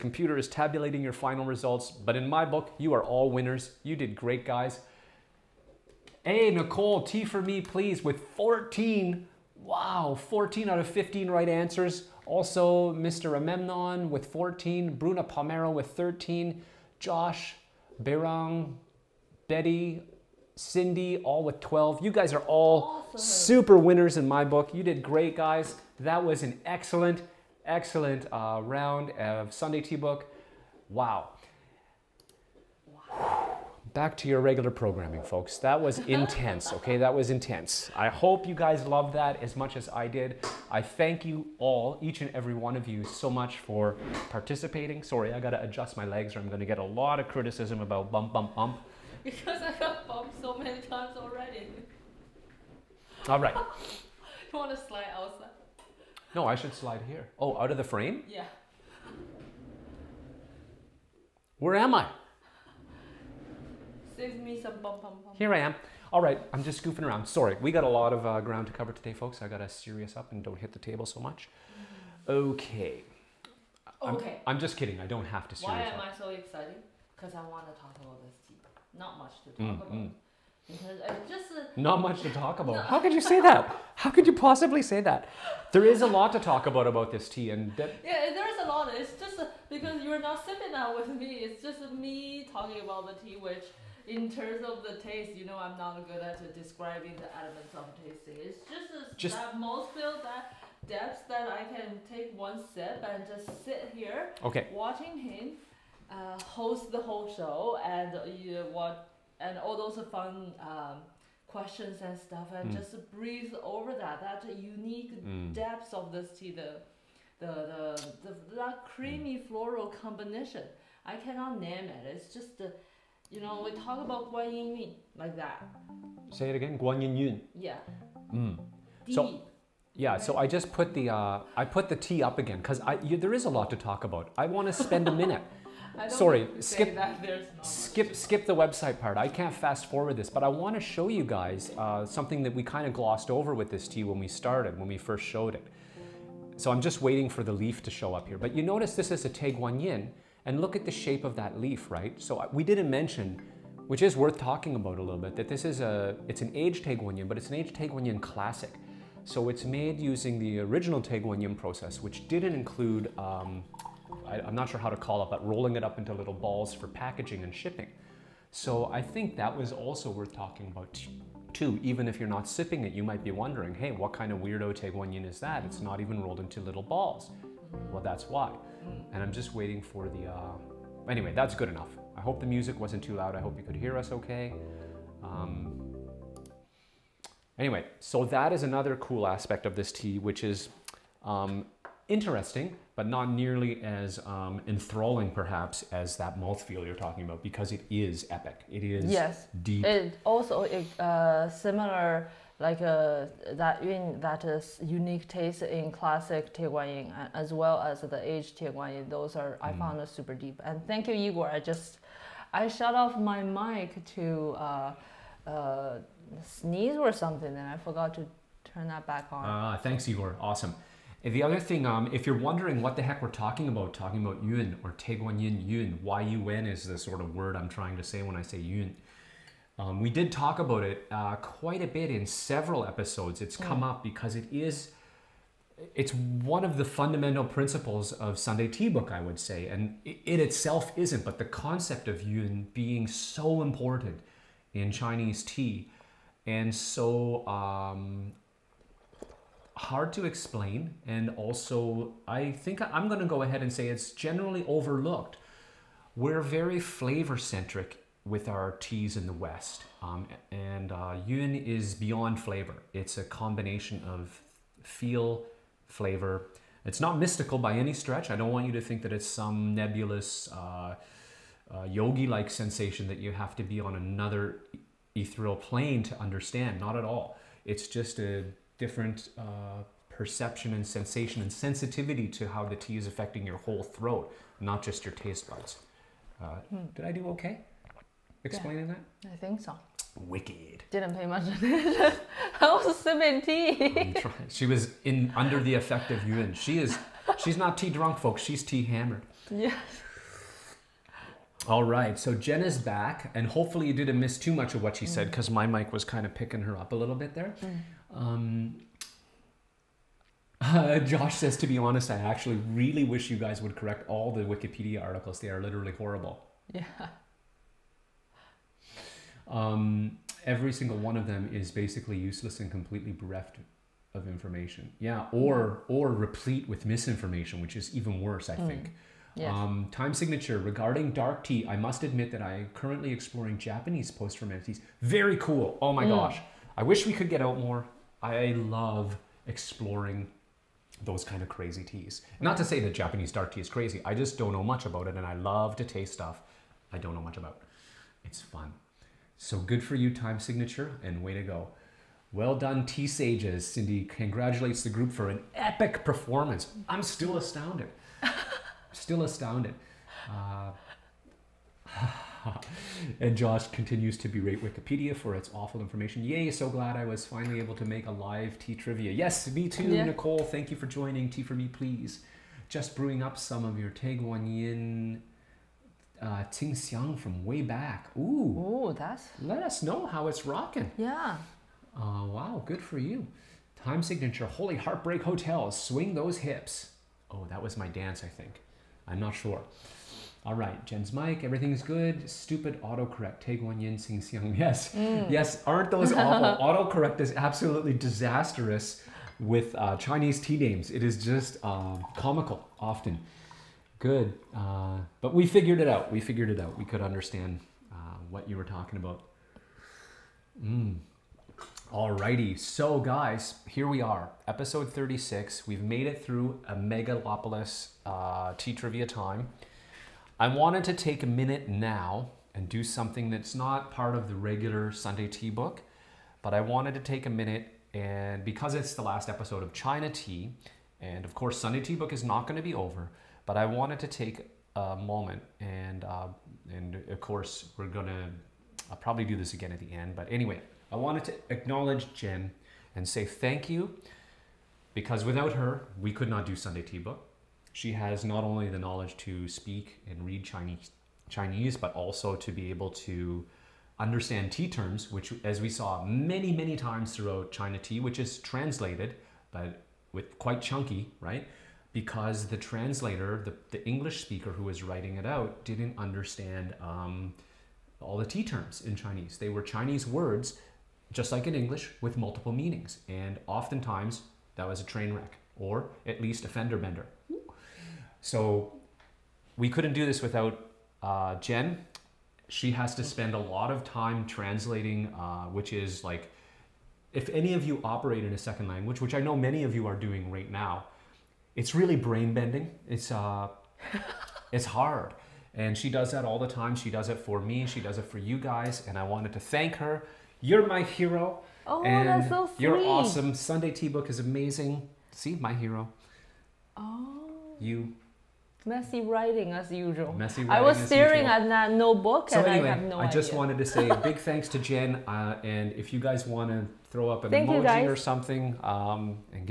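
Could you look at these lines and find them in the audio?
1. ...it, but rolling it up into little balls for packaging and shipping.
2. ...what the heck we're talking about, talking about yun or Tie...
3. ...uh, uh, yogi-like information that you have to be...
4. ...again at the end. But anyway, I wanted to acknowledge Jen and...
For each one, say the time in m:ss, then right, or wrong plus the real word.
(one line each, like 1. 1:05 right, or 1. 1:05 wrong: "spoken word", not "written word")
1. 2:45 right
2. 3:42 right
3. 4:30 wrong: "sensation", not "information"
4. 7:19 right.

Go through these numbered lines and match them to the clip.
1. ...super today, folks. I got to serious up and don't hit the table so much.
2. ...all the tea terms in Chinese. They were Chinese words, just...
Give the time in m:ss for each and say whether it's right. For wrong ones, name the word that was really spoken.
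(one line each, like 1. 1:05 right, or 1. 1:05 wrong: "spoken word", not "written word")
1. 1:08 wrong: "cover", not "super"
2. 7:48 right.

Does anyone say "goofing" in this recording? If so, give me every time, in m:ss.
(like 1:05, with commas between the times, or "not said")
1:06.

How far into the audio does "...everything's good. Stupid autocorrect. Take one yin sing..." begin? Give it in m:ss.
6:31.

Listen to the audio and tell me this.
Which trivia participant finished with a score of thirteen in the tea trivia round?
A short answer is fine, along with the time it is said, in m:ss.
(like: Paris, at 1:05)
Bruna Palmero, at 0:14.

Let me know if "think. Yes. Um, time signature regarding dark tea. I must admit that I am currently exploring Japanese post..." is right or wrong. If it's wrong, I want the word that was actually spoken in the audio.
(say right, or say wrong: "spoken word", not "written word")
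right.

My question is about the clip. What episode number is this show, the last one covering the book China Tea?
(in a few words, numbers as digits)
36.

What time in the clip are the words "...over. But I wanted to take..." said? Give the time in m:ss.
7:12.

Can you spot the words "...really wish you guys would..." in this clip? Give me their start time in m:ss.
5:12.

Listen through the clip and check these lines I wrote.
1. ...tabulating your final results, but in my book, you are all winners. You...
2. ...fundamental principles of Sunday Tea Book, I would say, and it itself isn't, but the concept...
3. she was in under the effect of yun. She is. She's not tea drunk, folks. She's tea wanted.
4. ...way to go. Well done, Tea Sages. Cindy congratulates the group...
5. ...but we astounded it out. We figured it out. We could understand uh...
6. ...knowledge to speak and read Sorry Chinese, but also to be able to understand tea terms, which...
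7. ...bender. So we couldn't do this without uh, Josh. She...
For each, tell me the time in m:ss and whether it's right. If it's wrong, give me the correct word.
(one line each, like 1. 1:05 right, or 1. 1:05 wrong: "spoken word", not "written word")
1. 0:00 right
2. 3:56 right
3. 4:54 wrong: "hammered", not "wanted"
4. 5:51 right
5. 6:45 wrong: "figured", not "astounded"
6. 7:28 wrong: "Chinese", not "Sorry"
7. 7:56 wrong: "Jen", not "Josh".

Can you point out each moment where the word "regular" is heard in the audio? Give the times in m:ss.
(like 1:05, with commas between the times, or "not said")
0:34, 7:04.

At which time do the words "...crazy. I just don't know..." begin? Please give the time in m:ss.
5:43.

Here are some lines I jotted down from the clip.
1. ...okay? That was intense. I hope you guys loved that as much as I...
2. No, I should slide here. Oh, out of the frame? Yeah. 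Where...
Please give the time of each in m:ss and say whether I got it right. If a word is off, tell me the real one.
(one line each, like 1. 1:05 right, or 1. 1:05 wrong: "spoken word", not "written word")
1. 0:36 right
2. 0:56 right.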